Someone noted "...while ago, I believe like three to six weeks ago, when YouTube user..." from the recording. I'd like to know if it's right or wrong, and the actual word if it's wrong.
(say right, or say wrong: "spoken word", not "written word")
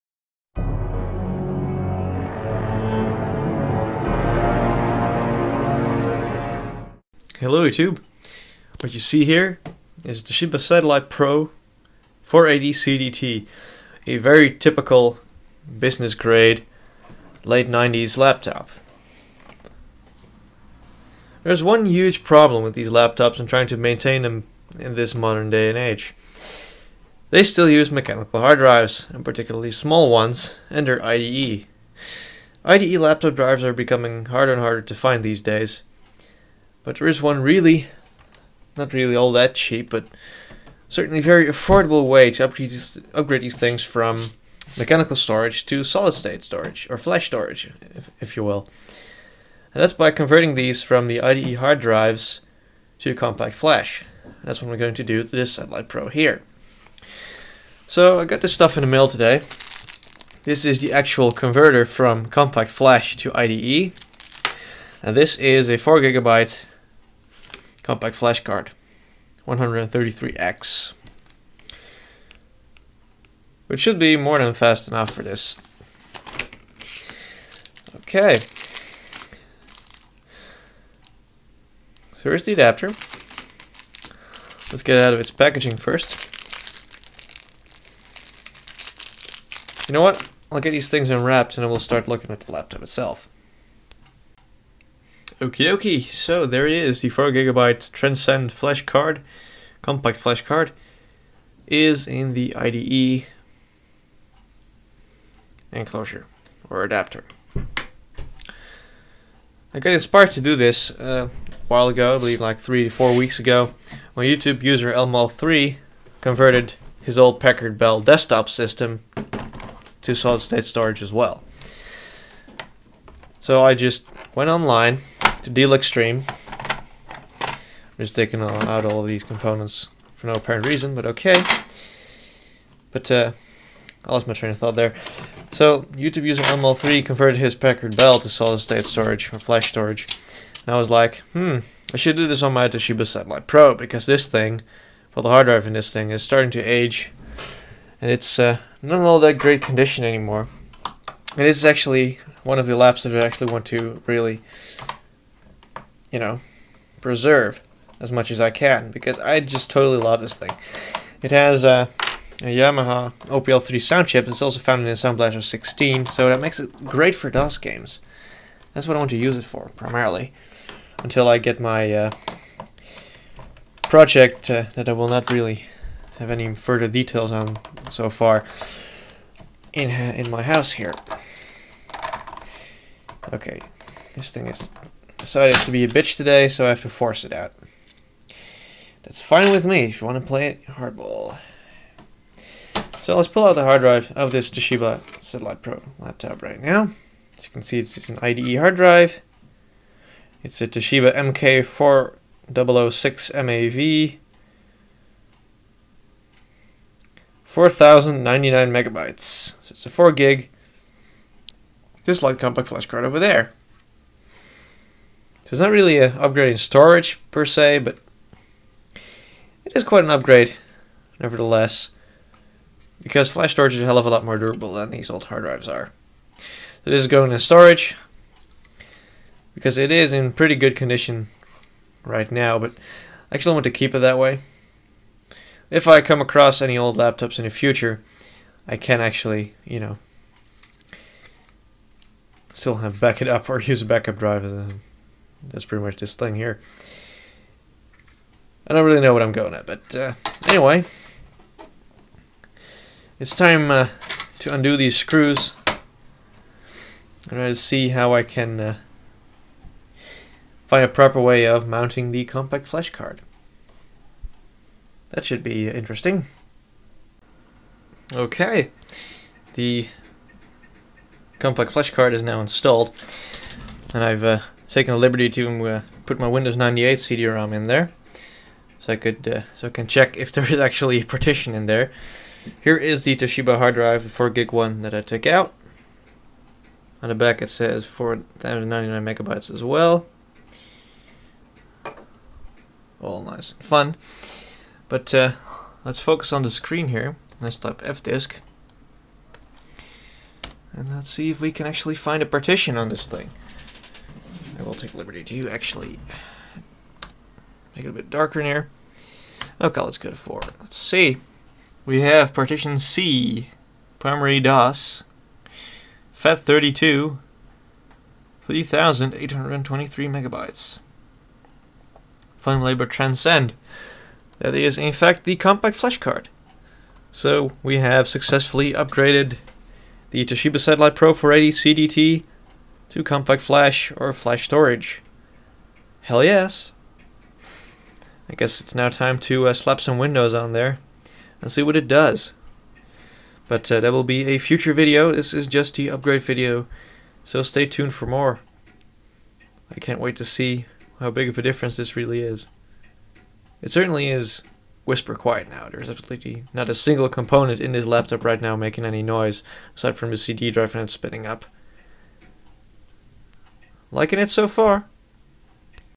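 wrong: "four", not "six".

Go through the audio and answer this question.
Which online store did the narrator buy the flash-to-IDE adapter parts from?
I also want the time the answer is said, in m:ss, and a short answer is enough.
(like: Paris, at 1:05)
Deal Extreme, at 2:05.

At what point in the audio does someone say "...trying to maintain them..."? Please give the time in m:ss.
0:23.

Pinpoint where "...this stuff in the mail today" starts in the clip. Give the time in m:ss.
0:58.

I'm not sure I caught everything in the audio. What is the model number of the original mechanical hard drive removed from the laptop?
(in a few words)
MK4006MAV.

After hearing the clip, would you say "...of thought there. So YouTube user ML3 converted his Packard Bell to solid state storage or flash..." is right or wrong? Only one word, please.
right.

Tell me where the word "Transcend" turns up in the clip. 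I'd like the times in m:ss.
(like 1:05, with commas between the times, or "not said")
1:37, 5:22.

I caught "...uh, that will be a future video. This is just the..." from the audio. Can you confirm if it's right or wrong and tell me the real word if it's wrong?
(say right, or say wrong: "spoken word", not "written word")
right.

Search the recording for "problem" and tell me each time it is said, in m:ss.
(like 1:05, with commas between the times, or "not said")
0:22.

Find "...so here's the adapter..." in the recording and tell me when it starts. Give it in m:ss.
1:22.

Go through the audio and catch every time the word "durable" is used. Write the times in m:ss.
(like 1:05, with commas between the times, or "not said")
3:44.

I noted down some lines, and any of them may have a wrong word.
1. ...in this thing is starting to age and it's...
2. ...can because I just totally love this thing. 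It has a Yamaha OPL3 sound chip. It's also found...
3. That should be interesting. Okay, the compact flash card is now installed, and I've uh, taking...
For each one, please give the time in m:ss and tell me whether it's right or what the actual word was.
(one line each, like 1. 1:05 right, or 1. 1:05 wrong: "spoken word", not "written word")
1. 2:25 right
2. 2:38 right
3. 4:25 right.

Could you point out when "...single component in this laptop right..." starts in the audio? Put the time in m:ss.
5:56.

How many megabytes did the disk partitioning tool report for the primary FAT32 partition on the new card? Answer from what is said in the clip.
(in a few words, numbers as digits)
3,823.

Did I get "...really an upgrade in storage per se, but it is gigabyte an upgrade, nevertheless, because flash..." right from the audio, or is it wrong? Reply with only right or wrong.
wrong.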